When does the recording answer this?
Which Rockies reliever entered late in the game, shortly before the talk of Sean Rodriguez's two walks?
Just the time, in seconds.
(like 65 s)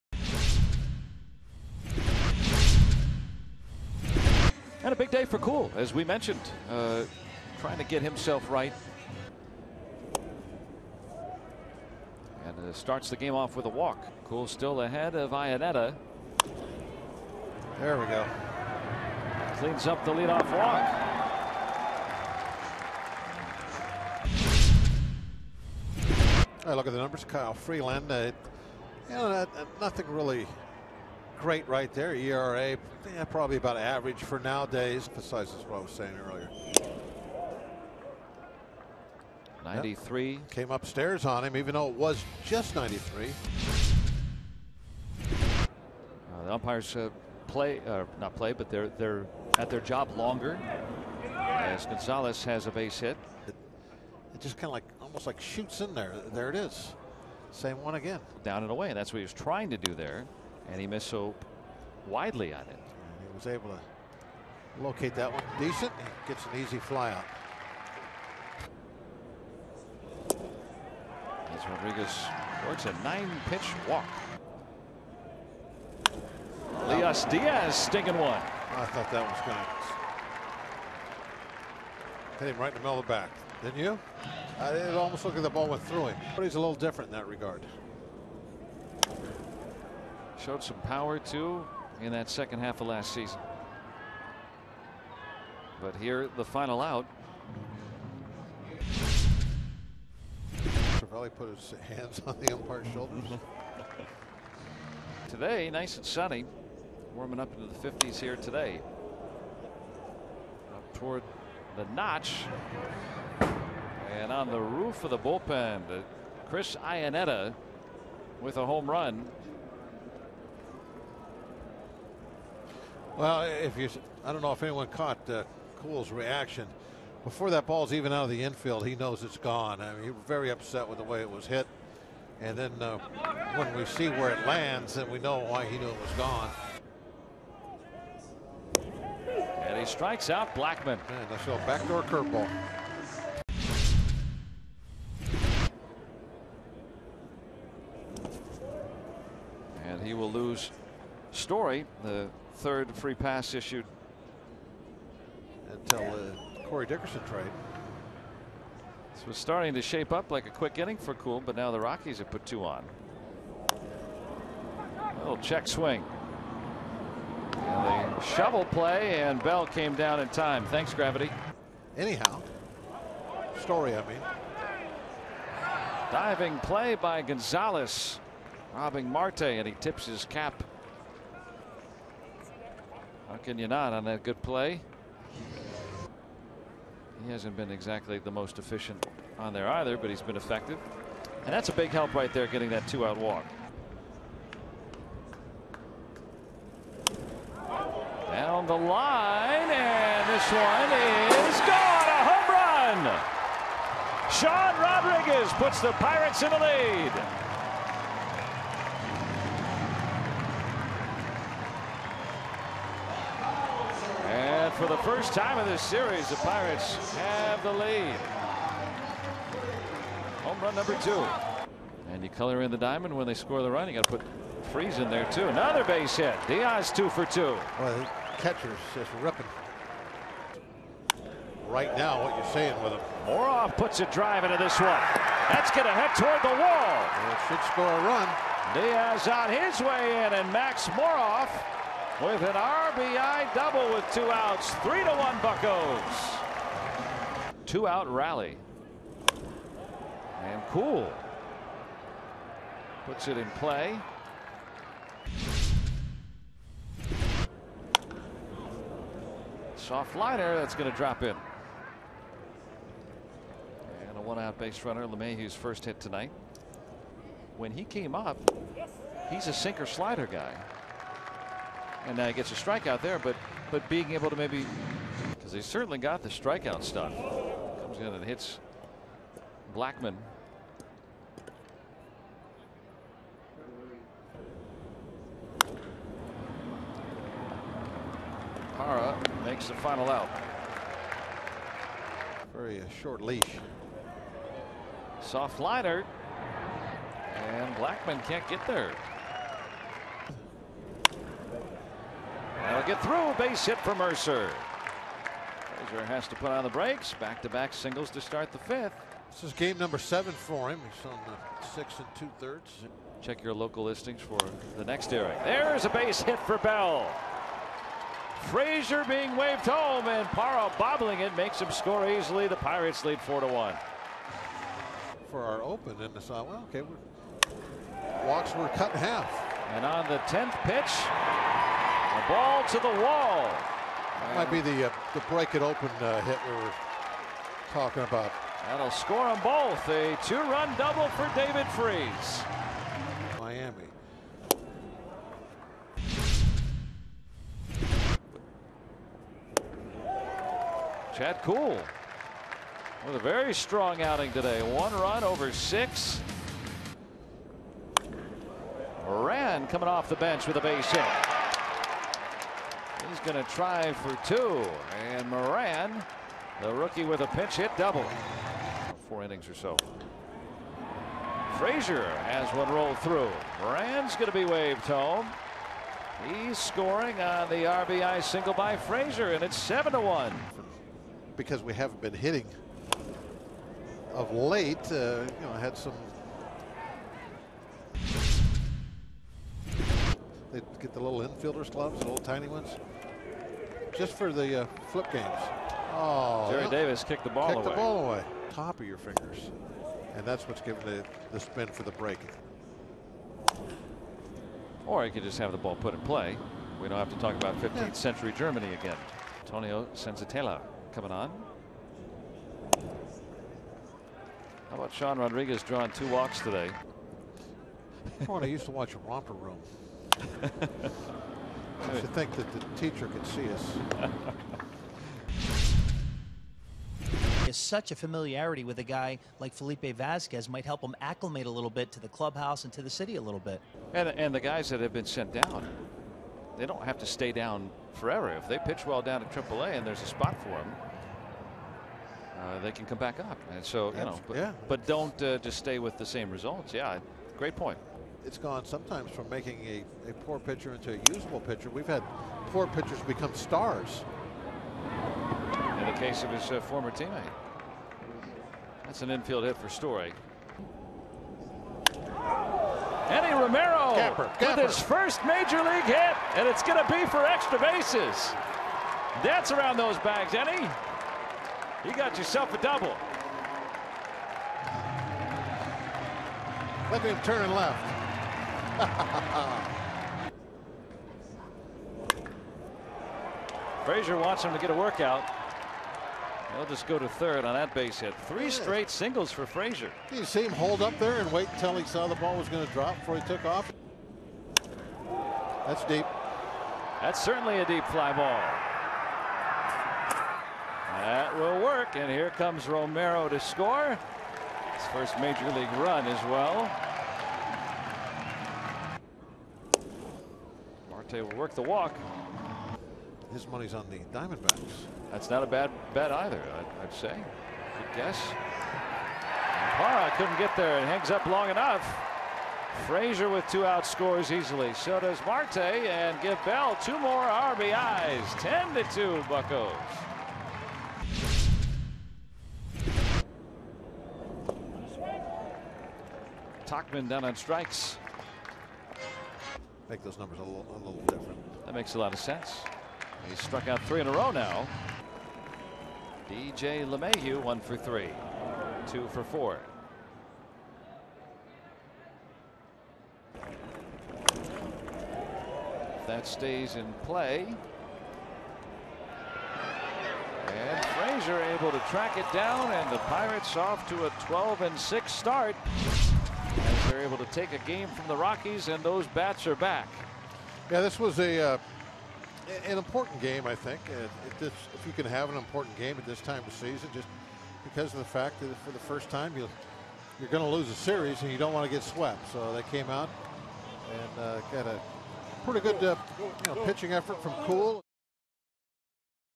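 409 s.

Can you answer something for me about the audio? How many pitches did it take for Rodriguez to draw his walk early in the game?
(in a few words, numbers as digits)
9.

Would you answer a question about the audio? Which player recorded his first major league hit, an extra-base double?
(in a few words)
Eddie Romero.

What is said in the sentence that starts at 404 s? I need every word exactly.
Or he could just have the ball put in play.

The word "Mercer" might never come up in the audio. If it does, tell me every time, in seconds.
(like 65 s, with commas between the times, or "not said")
303 s.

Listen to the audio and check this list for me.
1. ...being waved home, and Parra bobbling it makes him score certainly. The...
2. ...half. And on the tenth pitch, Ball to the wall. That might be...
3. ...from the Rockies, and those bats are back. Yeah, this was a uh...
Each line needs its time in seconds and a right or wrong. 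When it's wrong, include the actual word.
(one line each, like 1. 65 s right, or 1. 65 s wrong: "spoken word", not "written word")
1. 319 s wrong: "easily", not "certainly"
2. 329 s right
3. 567 s right.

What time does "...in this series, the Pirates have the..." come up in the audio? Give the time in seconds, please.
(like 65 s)
215 s.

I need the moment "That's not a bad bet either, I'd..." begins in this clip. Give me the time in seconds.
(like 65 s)
515 s.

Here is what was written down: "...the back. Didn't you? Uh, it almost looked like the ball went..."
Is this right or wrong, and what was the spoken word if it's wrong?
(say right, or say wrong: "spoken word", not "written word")
right.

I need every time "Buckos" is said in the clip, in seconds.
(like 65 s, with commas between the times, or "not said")
245 s, 529 s.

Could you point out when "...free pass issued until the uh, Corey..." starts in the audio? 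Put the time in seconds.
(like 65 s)
152 s.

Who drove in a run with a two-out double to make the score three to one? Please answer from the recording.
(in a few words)
Max Moroff.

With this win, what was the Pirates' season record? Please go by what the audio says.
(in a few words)
12 and 6.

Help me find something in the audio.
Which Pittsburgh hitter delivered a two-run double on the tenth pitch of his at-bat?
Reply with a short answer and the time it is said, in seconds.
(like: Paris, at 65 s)
David Freese, at 341 s.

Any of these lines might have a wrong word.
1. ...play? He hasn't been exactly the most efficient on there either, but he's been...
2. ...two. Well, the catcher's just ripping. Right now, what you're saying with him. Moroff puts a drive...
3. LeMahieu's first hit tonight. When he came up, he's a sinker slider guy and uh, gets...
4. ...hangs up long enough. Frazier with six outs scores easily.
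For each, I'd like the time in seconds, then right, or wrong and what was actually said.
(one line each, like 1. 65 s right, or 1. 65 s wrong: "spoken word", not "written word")
1. 184 s right
2. 227 s right
3. 265 s right
4. 520 s wrong: "two", not "six".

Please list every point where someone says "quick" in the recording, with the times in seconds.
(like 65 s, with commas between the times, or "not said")
160 s.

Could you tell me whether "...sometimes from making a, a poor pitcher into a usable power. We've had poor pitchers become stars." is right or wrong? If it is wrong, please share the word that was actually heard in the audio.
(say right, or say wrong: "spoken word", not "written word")
wrong: "pitcher", not "power".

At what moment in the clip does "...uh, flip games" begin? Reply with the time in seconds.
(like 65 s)
394 s.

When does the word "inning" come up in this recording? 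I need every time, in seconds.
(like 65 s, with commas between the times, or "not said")
160 s, 369 s.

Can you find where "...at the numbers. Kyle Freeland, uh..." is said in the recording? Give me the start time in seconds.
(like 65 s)
26 s.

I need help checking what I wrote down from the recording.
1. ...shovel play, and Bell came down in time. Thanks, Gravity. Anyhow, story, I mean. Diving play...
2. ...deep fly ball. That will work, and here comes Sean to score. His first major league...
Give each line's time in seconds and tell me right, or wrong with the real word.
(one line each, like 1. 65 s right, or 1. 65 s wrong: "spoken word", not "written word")
1. 168 s right
2. 497 s wrong: "Romero", not "Sean".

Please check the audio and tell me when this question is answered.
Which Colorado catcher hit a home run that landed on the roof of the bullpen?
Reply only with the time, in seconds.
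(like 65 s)
116 s.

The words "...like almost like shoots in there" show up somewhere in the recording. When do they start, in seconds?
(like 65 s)
54 s.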